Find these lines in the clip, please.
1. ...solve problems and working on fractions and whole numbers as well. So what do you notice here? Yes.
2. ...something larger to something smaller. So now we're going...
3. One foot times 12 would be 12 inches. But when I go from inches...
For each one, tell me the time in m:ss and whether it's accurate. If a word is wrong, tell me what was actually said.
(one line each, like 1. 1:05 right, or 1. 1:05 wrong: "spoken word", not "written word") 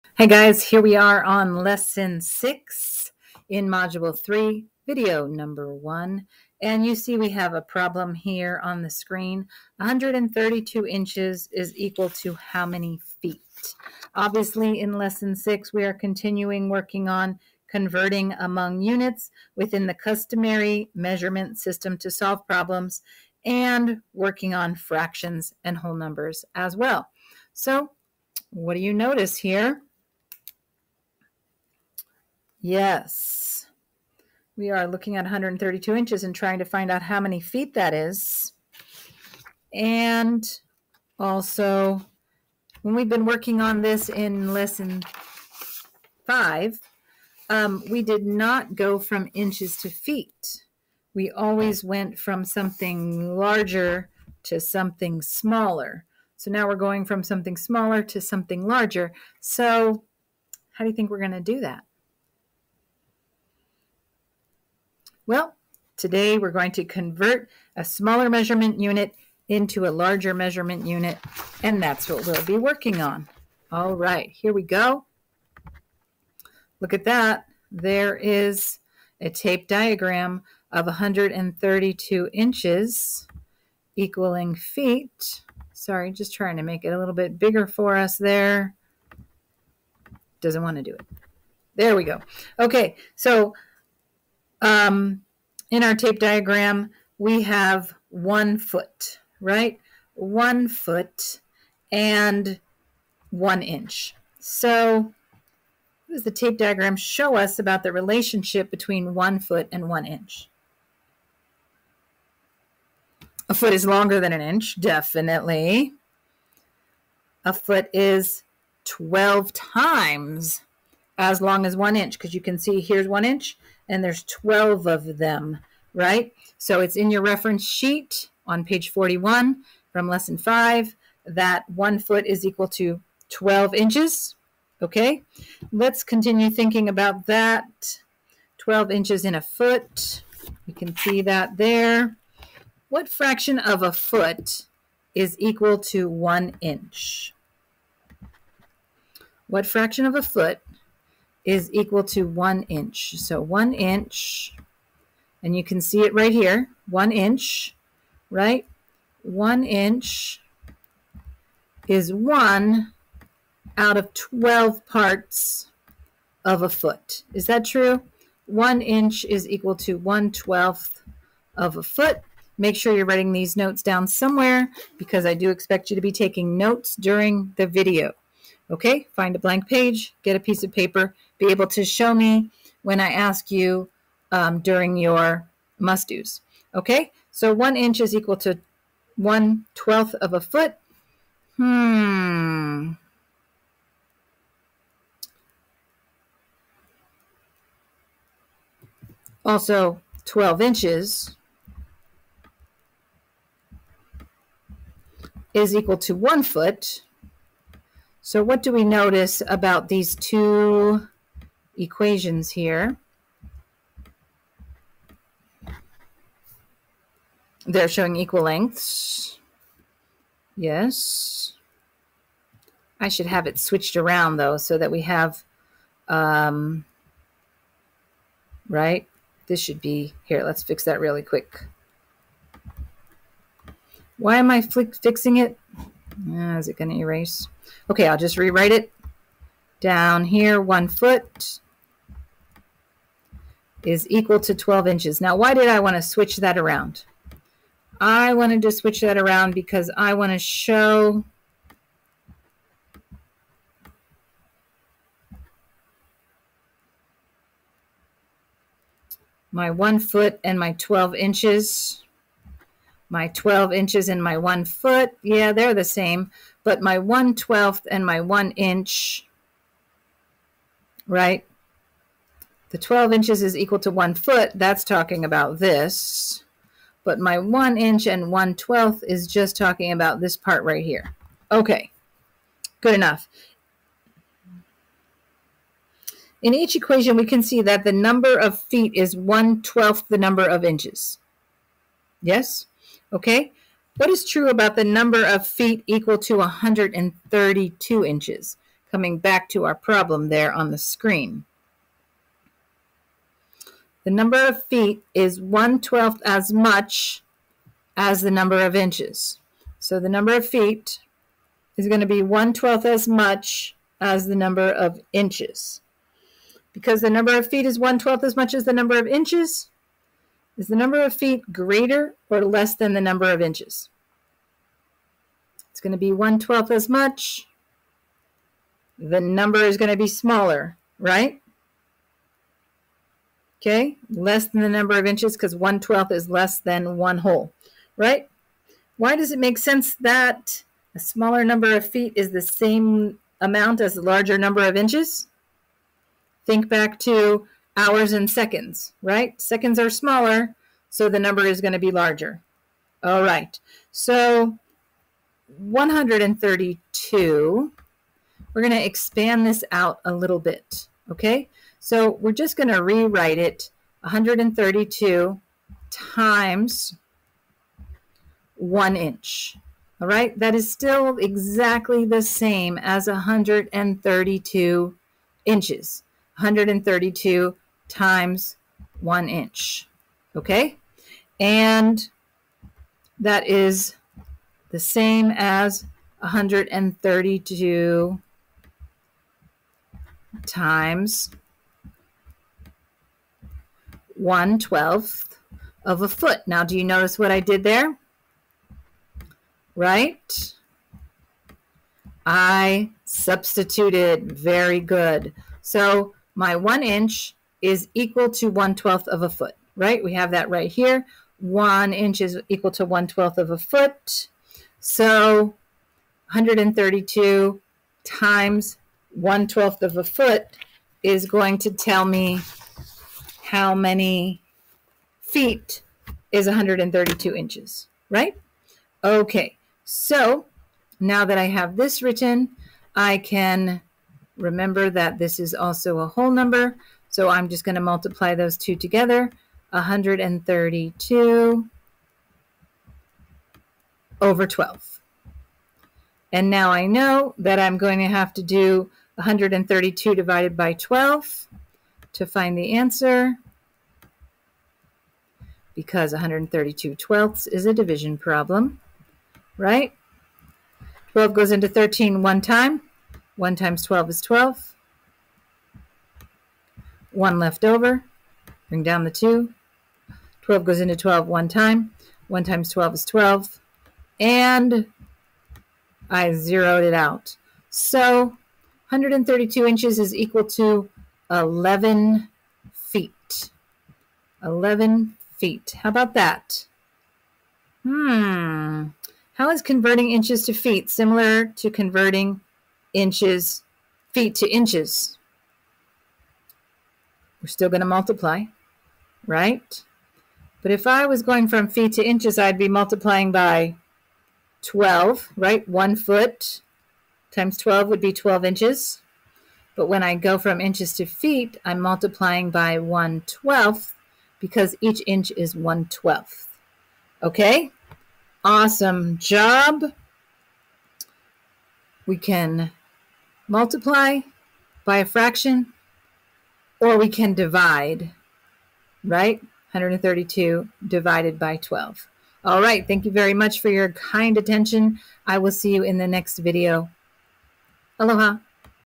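1. 0:22 right
2. 0:52 right
3. 8:25 right.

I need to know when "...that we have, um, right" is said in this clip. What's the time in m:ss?
3:44.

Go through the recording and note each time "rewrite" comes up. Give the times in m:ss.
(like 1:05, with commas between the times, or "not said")
3:58, 6:02.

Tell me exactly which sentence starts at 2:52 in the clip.
Make sure you're writing these notes down somewhere because I do expect you to be taking notes during the video.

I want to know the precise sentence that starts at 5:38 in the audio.
Why does it make sense that a smaller number of feet is the same amount as a larger number of inches?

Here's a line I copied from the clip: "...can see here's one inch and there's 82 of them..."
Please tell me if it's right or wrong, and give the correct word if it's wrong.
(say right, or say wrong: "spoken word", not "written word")
wrong: "12", not "82".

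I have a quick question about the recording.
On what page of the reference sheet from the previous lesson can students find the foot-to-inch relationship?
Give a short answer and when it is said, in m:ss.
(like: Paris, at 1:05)
41, at 2:08.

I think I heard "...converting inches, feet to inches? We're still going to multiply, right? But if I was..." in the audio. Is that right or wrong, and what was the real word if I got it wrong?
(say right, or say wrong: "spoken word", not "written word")
right.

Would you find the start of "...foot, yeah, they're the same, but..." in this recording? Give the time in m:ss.
4:24.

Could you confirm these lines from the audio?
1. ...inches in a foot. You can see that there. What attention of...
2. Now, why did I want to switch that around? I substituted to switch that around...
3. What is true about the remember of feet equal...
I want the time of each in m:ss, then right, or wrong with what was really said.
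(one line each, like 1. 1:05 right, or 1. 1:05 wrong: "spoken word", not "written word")
1. 2:18 wrong: "fraction", not "attention"
2. 4:05 wrong: "wanted", not "substituted"
3. 4:53 wrong: "number", not "remember".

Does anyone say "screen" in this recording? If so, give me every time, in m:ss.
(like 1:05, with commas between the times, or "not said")
0:08, 5:00.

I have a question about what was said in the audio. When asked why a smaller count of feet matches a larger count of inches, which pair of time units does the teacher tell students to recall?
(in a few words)
hours and seconds.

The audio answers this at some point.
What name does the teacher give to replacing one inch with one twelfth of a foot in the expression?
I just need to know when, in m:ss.
6:43.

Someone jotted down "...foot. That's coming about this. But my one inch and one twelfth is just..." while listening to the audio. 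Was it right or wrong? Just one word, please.
wrong.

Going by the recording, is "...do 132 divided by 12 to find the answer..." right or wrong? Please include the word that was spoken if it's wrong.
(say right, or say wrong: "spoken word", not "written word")
right.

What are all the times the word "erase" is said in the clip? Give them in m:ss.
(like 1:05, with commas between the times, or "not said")
3:56.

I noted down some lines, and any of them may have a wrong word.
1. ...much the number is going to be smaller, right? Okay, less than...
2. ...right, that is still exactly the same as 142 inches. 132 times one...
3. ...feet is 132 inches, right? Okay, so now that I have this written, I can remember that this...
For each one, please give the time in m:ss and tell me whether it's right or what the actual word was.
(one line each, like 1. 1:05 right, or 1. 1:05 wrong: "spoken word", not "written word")
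1. 5:26 right
2. 6:10 wrong: "132", not "142"
3. 7:05 right.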